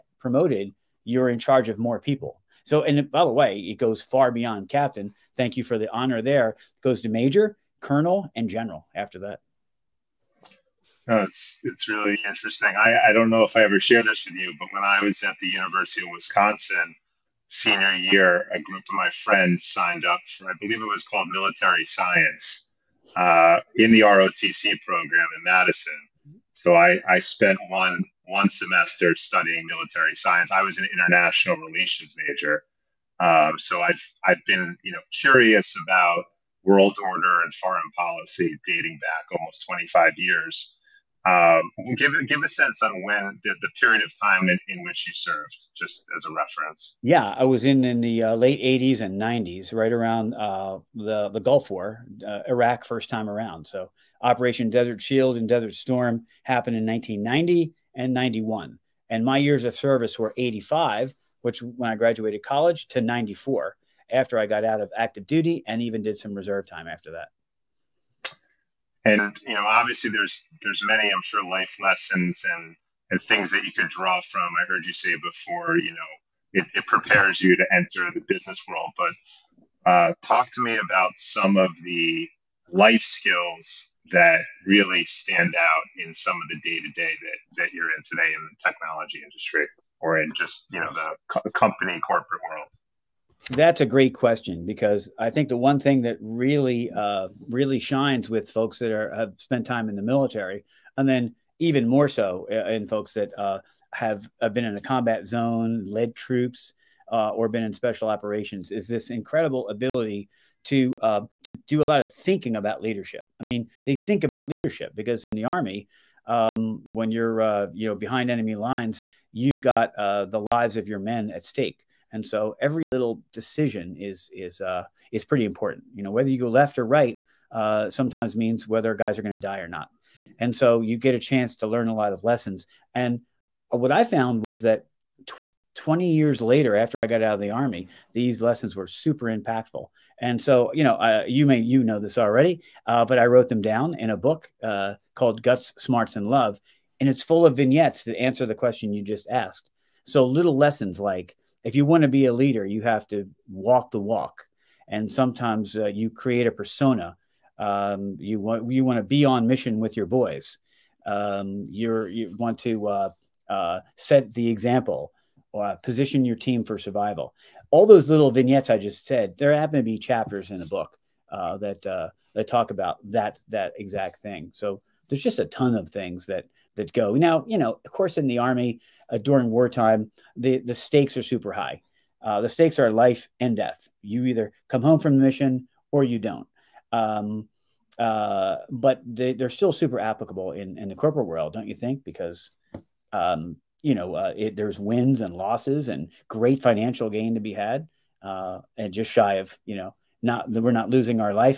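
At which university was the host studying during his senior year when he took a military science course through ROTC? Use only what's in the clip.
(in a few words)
University of Wisconsin.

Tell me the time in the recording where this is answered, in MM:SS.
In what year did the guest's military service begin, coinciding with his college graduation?
01:00.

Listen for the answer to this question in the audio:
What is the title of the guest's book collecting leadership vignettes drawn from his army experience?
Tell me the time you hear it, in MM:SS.
02:25.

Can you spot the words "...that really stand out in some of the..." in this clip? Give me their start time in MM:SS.
01:24.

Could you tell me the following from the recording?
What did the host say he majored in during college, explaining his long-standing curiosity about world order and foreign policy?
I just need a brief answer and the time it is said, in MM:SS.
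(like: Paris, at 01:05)
International relations, at 00:30.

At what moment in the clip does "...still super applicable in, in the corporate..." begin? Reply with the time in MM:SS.
03:09.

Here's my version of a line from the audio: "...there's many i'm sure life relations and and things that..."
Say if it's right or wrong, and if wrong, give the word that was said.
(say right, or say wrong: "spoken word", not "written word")
wrong: "lessons", not "relations".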